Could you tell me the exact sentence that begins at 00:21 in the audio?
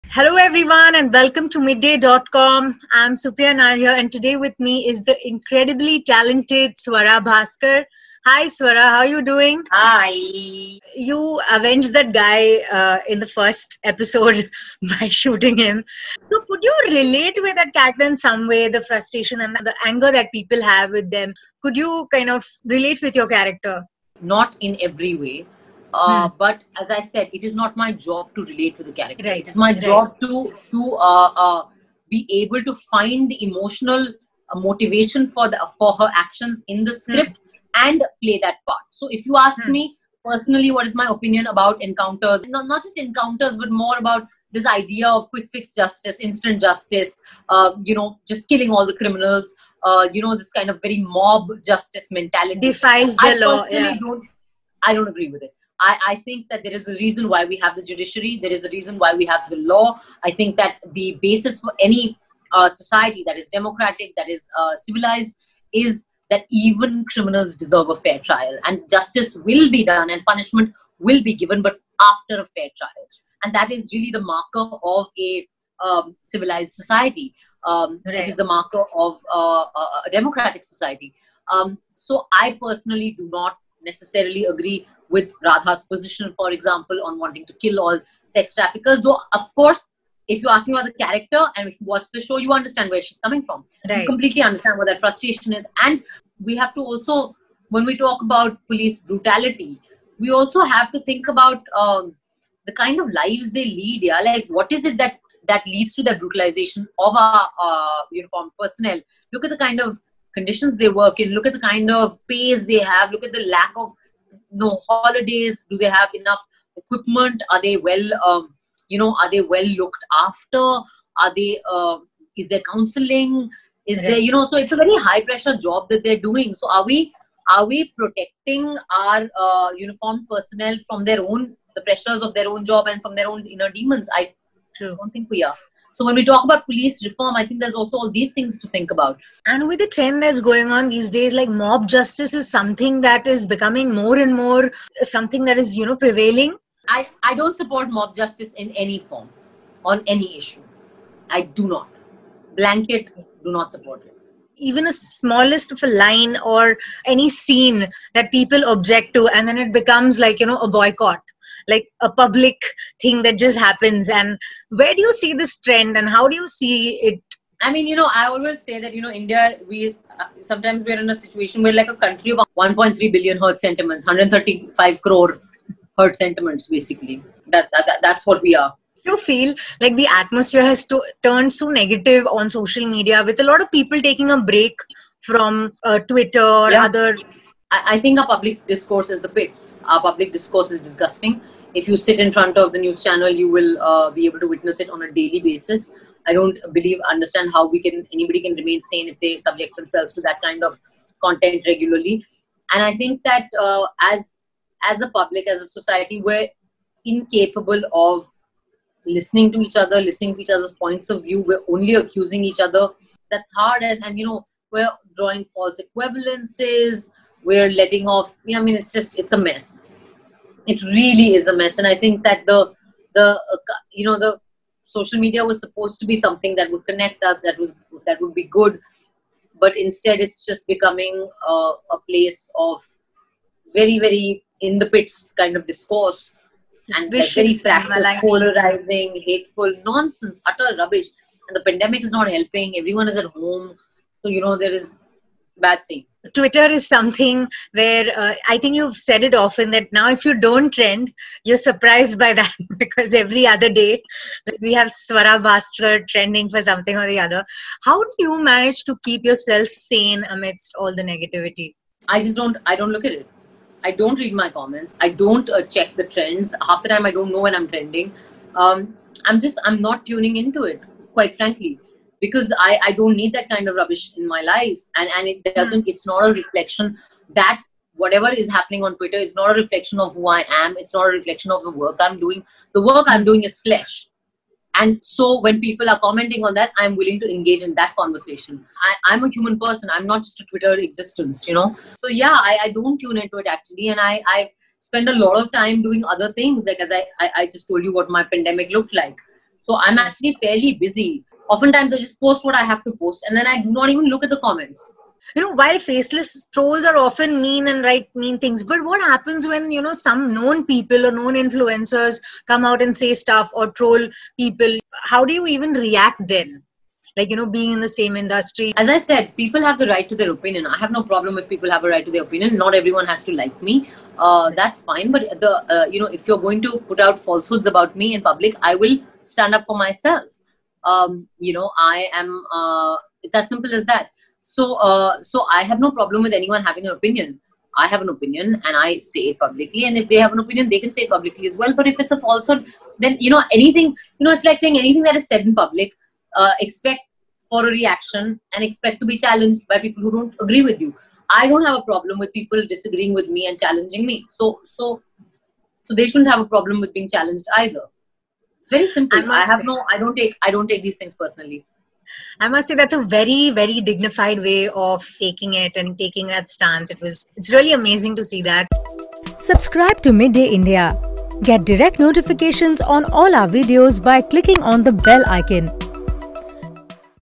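Could you kind of relate with your character?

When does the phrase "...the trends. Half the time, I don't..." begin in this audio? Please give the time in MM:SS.
04:25.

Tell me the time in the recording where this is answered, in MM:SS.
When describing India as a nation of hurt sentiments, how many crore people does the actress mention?
02:54.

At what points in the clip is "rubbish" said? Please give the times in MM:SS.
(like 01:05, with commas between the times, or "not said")
04:00, 04:33.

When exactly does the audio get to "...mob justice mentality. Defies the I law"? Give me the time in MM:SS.
00:51.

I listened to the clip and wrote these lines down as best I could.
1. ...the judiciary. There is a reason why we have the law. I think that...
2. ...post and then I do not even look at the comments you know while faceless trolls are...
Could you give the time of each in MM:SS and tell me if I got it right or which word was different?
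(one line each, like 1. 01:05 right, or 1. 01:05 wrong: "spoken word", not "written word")
1. 00:57 right
2. 05:02 right.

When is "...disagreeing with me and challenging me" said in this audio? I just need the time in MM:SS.
05:52.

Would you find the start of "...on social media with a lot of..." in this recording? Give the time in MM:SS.
03:02.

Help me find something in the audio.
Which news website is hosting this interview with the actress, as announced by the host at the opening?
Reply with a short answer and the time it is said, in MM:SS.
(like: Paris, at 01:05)
midday.com, at 00:01.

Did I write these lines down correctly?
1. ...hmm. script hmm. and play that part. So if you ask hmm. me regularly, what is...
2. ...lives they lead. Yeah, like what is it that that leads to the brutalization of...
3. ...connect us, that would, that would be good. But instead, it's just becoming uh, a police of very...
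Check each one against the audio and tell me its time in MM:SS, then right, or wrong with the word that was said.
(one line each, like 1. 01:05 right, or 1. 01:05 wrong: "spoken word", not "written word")
1. 00:36 wrong: "personally", not "regularly"
2. 01:43 right
3. 03:46 wrong: "place", not "police".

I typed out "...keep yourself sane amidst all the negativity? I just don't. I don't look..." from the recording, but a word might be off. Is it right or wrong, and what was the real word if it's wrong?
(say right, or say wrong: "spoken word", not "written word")
right.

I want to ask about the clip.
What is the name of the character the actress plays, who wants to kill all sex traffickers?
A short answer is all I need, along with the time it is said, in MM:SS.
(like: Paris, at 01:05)
Radha, at 01:25.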